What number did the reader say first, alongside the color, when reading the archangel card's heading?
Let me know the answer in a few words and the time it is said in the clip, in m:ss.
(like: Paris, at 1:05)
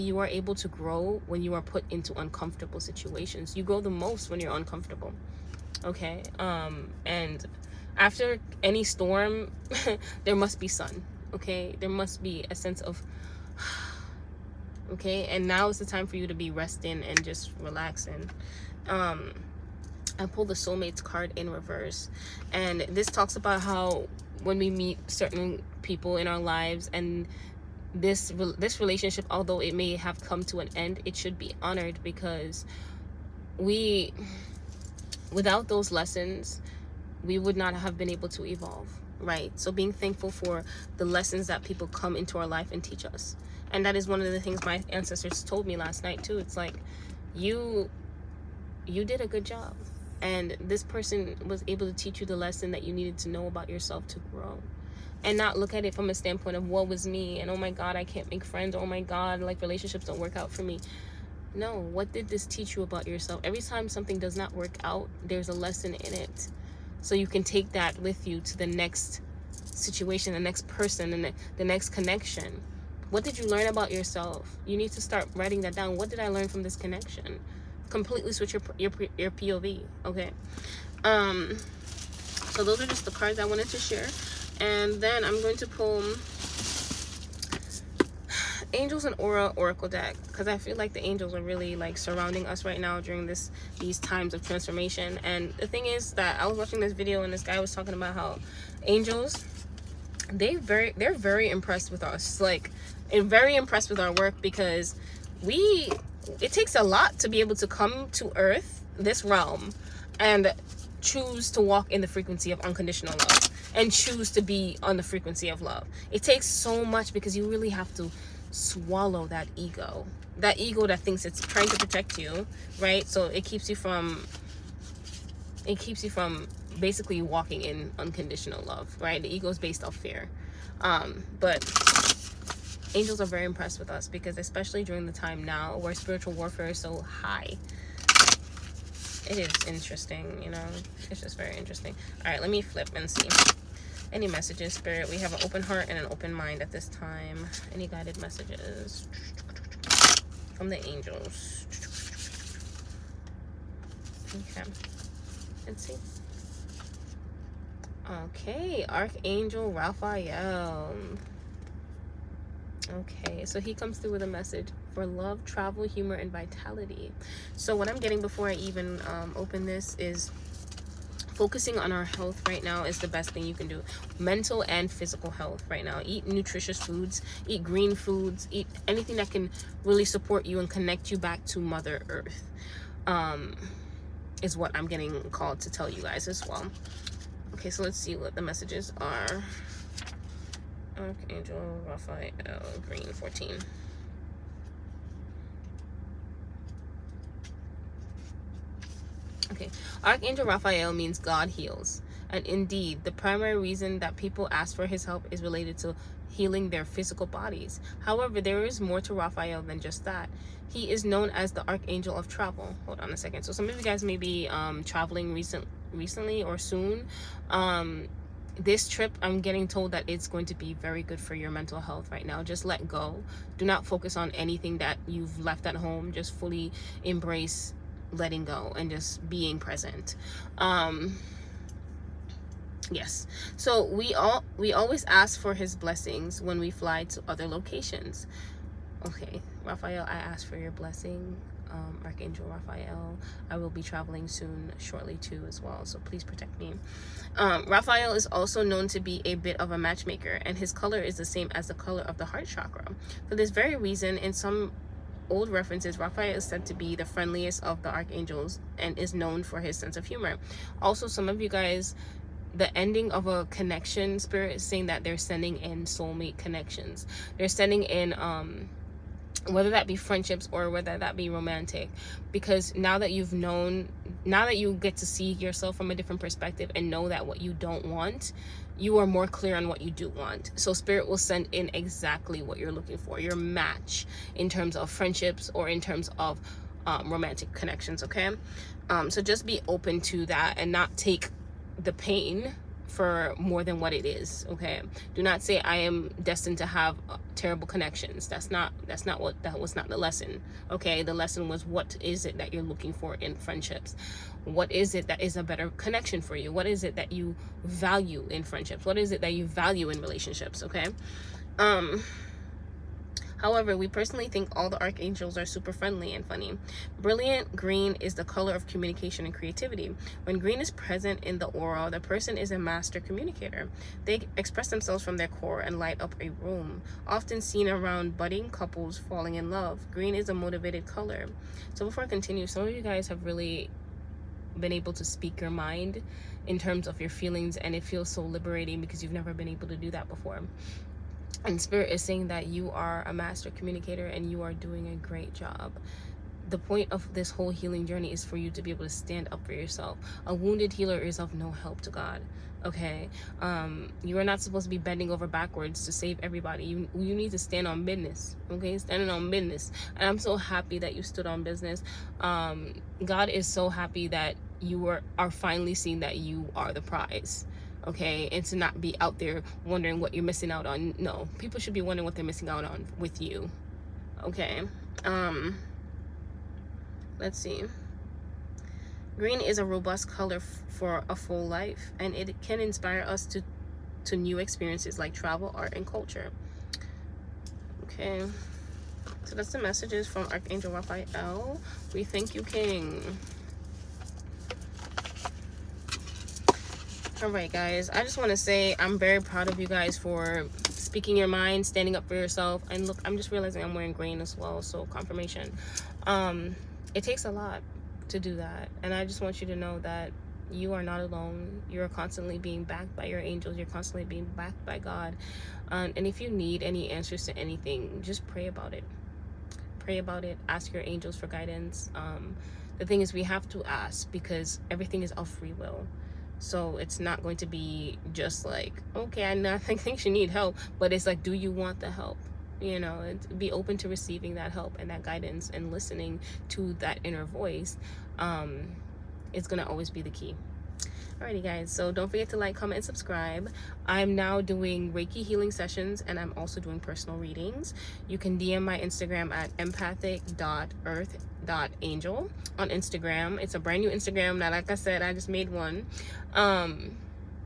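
14, at 3:12.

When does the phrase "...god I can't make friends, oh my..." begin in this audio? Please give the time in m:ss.
0:57.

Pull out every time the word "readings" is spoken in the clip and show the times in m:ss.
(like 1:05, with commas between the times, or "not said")
7:27.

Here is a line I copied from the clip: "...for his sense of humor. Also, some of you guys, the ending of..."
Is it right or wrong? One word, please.
right.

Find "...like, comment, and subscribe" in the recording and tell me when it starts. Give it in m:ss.
7:22.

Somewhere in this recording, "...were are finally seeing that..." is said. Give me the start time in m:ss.
6:04.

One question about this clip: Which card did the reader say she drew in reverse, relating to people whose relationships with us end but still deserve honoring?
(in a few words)
Soulmates card.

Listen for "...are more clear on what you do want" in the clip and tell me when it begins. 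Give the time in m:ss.
4:38.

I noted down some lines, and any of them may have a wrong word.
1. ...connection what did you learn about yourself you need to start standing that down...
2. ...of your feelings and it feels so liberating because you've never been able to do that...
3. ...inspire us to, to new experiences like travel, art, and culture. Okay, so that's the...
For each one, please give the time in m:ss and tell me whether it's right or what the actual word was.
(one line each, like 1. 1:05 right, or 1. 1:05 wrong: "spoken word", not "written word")
1. 1:11 wrong: "writing", not "standing"
2. 5:36 right
3. 6:22 right.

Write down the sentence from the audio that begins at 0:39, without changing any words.
So being thankful for the lessons that people come into our life and teach us.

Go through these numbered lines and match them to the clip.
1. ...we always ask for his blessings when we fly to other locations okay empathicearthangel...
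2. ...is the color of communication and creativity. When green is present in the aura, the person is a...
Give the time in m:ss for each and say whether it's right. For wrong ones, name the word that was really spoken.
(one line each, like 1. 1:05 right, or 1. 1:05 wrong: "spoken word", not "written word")
1. 3:54 wrong: "raphael", not "empathicearthangel"
2. 5:17 right.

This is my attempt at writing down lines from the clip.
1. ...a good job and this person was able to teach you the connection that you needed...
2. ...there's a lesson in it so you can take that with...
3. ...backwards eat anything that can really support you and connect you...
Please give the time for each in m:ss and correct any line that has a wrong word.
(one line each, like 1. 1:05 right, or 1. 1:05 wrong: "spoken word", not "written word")
1. 0:49 wrong: "lesson", not "connection"
2. 1:05 right
3. 2:57 wrong: "foods", not "backwards".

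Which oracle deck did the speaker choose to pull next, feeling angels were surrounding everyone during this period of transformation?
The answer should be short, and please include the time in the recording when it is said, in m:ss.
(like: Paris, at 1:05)
Angels and aura, at 1:28.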